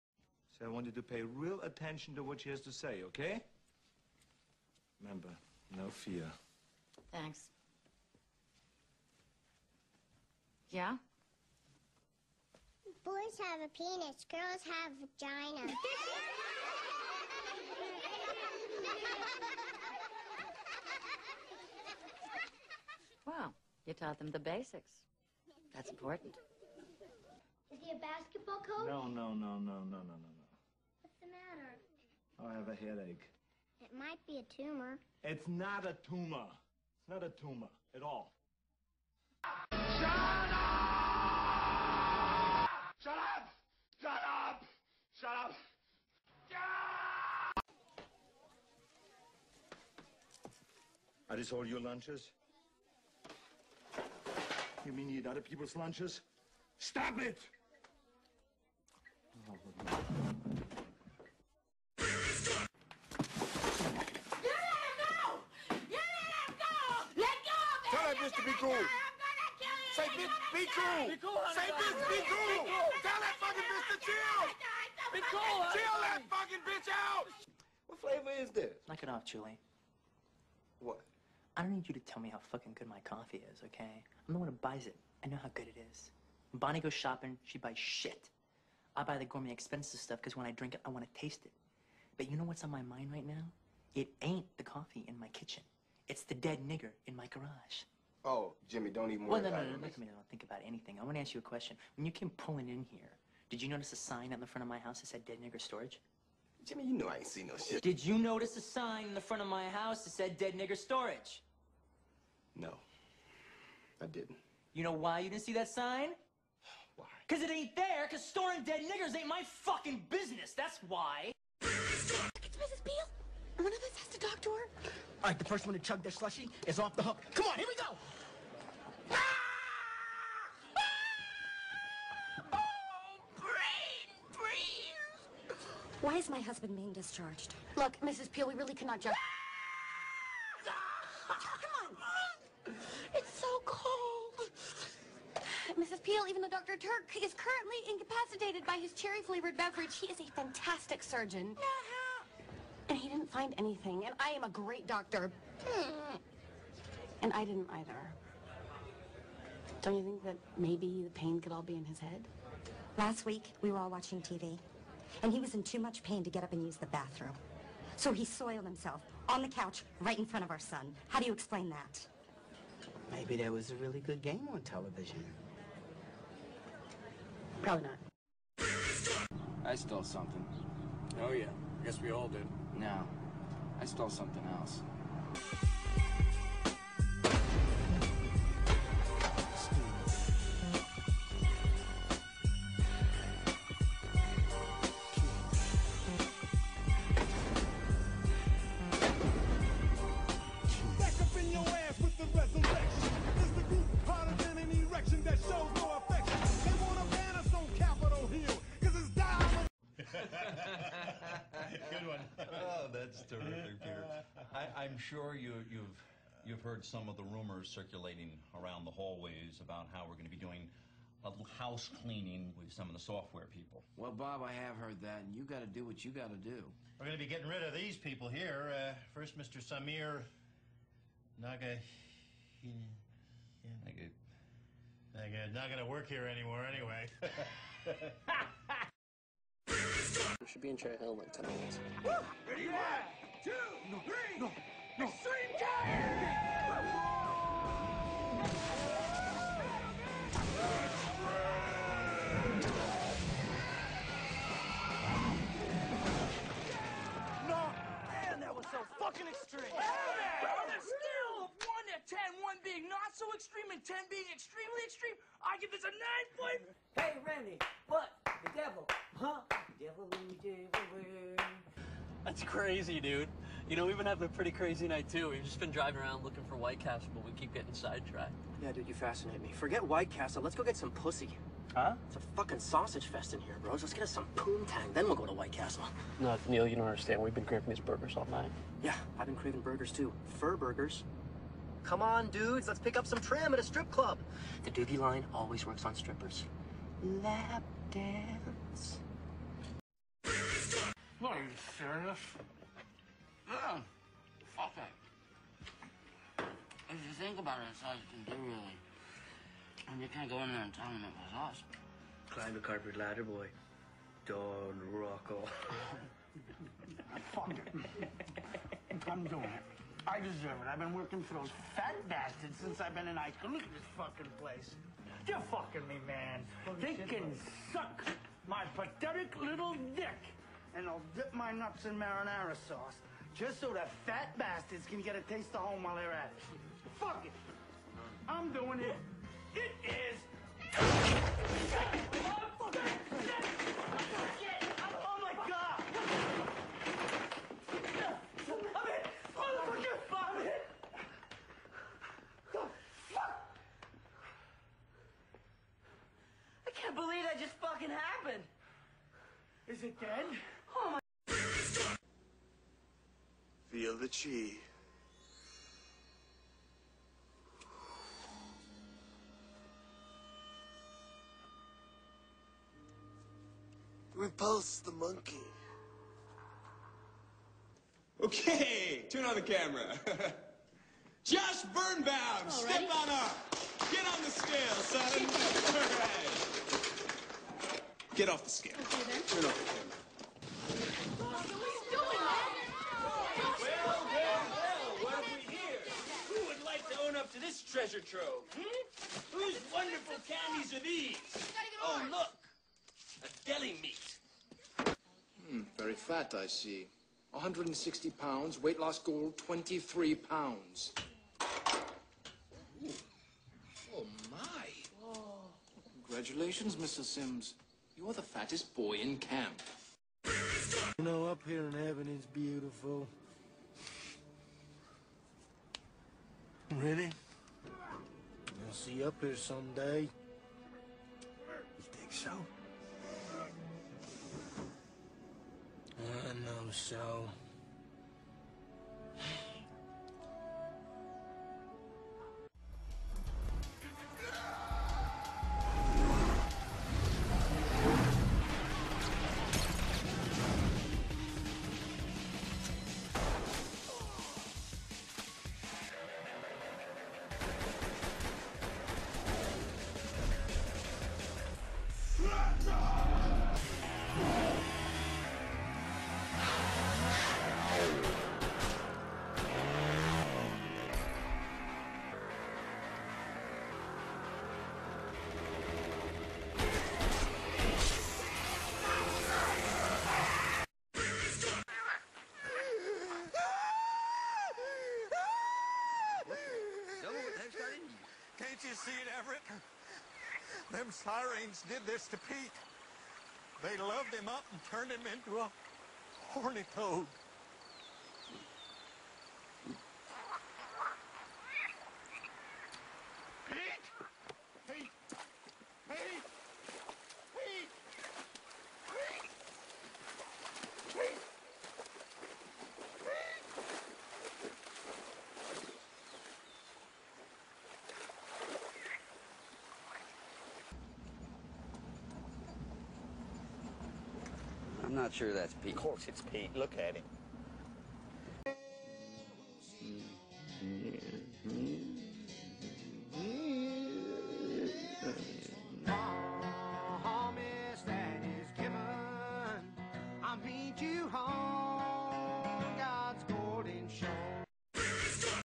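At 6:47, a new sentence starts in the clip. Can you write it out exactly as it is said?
160 pounds, weight loss goal 23 pounds.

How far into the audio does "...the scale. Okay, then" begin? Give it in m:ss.
6:28.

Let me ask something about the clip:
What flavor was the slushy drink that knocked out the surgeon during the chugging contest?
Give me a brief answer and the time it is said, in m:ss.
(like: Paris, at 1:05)
Cherry, at 2:28.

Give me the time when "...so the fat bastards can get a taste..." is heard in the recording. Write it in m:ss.
5:33.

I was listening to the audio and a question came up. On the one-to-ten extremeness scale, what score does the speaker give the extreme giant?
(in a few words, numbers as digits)
9.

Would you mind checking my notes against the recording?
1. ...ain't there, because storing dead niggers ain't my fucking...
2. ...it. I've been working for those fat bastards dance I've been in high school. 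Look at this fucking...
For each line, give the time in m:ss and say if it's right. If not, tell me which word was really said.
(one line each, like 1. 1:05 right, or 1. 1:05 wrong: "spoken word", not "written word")
1. 1:57 right
2. 5:20 wrong: "since", not "dance".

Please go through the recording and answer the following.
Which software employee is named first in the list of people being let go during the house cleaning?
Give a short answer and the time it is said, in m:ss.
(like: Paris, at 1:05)
Samir Naga, at 3:49.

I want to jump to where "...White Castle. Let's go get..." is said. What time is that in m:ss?
4:39.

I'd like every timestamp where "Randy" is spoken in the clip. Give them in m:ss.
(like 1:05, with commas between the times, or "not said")
4:27.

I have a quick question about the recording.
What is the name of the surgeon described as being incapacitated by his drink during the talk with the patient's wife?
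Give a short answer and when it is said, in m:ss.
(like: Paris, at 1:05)
Dr. Turk, at 2:26.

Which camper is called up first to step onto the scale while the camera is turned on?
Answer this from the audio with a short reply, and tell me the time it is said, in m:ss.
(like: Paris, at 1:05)
Josh Birnbaum, at 6:21.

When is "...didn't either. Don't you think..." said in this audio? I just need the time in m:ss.
2:37.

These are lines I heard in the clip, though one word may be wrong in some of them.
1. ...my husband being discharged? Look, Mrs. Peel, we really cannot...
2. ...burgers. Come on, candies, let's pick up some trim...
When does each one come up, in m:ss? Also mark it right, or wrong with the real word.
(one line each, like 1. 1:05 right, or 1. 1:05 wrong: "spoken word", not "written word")
1. 2:16 right
2. 4:50 wrong: "dudes", not "candies".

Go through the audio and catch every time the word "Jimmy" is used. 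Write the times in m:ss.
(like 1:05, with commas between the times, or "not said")
1:38, 1:46.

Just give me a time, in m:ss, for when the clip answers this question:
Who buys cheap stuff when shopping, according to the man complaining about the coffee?
1:26.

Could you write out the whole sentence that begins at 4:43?
Let's get us some poontang, then we'll go to White Castle.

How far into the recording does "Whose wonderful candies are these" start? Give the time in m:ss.
6:39.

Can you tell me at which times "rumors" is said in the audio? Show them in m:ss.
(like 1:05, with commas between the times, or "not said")
3:37.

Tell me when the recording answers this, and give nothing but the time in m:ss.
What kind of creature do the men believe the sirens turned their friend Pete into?
8:16.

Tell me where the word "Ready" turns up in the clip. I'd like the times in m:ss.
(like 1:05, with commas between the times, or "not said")
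4:02, 7:06.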